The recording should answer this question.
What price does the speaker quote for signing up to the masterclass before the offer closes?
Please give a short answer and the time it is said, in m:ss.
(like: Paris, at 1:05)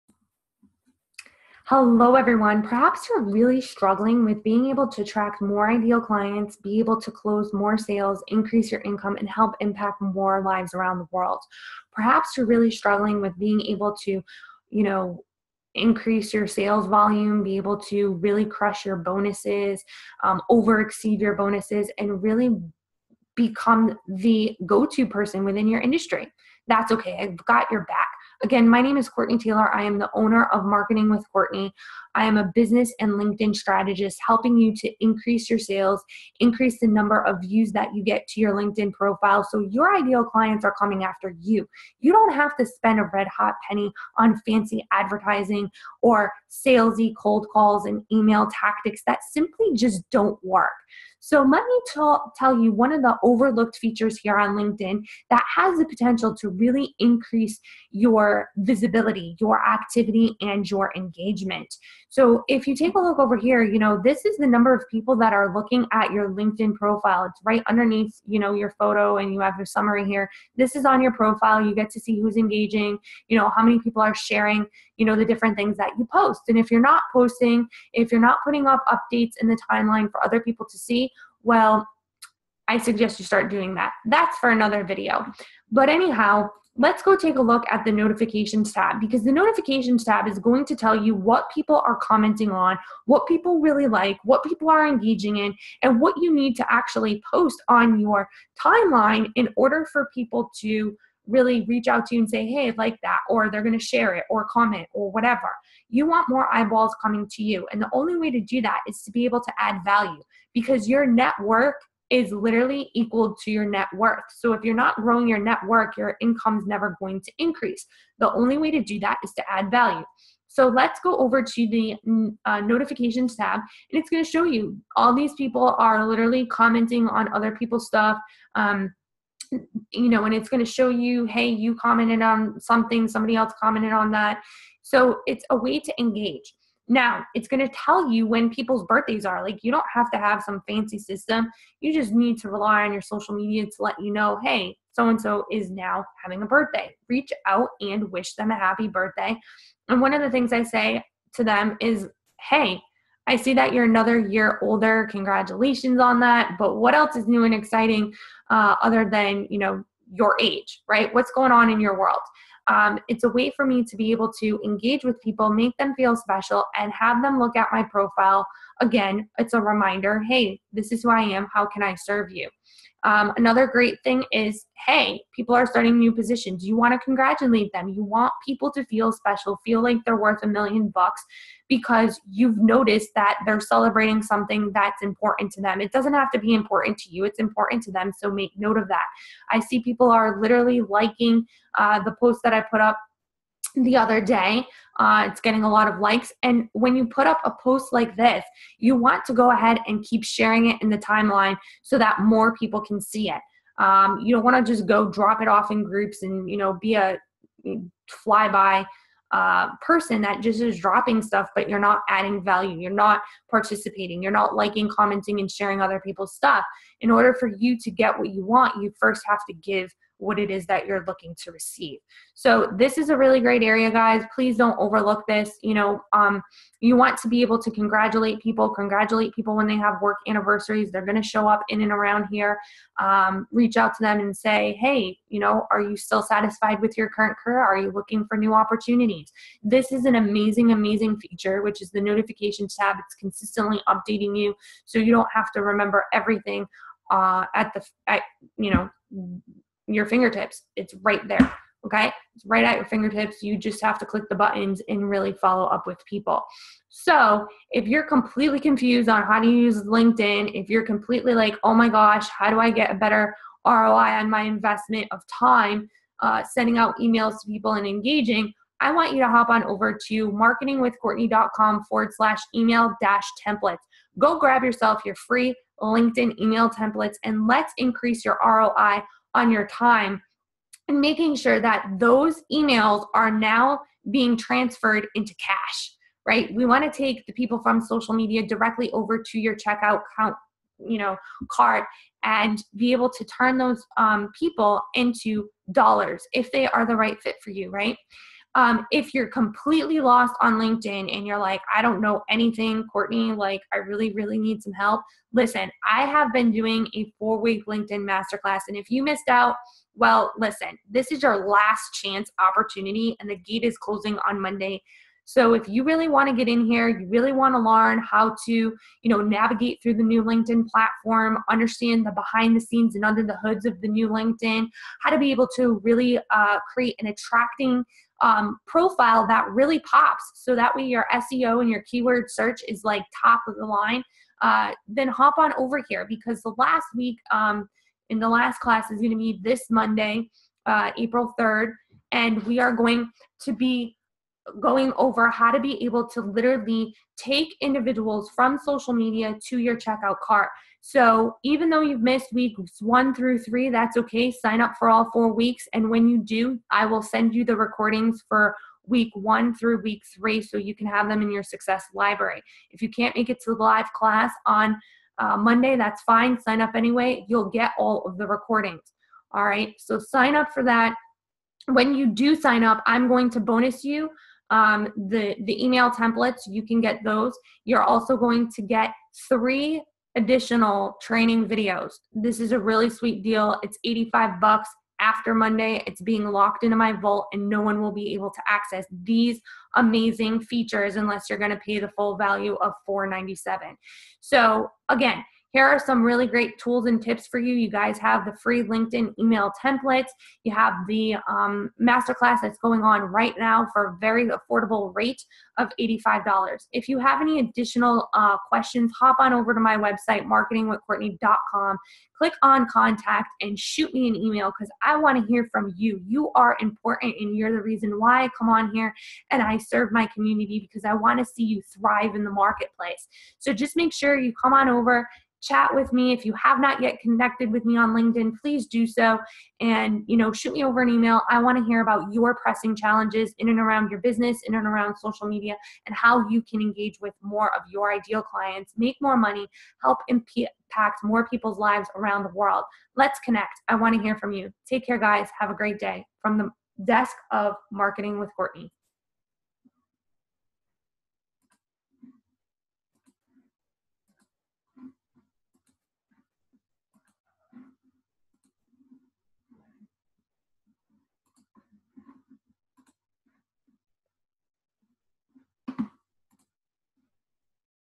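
$85, at 6:23.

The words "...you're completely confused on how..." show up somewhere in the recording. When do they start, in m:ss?
4:17.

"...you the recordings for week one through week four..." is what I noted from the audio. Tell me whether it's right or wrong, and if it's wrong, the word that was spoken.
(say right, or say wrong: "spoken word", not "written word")
wrong: "three", not "four".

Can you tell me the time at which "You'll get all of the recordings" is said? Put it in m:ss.
6:07.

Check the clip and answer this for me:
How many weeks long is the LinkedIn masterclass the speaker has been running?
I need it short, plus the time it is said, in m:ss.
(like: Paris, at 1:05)
4, at 5:07.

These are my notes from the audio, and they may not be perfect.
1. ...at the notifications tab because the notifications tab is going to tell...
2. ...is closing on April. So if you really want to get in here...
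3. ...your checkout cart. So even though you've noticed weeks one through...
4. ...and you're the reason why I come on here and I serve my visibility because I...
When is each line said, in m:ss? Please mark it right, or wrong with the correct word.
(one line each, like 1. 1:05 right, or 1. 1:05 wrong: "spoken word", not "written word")
1. 1:27 right
2. 5:13 wrong: "Monday", not "April"
3. 5:49 wrong: "missed", not "noticed"
4. 6:57 wrong: "community", not "visibility".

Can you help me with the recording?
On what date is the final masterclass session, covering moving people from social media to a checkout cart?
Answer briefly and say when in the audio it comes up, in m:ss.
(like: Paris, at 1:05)
April 3rd, at 5:40.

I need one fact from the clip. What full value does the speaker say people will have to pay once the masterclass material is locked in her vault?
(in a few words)
$497.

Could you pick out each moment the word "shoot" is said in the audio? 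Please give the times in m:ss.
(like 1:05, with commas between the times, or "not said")
6:53, 7:10.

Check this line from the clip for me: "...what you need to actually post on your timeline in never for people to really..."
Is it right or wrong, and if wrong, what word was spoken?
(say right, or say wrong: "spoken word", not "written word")
wrong: "order", not "never".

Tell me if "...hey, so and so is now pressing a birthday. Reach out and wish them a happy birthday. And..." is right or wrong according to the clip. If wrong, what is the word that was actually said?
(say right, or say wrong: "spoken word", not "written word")
wrong: "having", not "pressing".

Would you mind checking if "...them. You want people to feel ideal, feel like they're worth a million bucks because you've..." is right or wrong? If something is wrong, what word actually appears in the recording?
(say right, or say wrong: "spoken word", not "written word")
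wrong: "special", not "ideal".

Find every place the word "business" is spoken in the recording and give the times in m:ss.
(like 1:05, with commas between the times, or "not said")
0:32, 7:14.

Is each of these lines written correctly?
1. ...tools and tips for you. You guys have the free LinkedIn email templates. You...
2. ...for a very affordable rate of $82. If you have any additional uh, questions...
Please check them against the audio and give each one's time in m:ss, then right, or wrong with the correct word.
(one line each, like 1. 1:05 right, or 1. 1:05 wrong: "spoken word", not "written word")
1. 6:36 right
2. 6:43 wrong: "85", not "82".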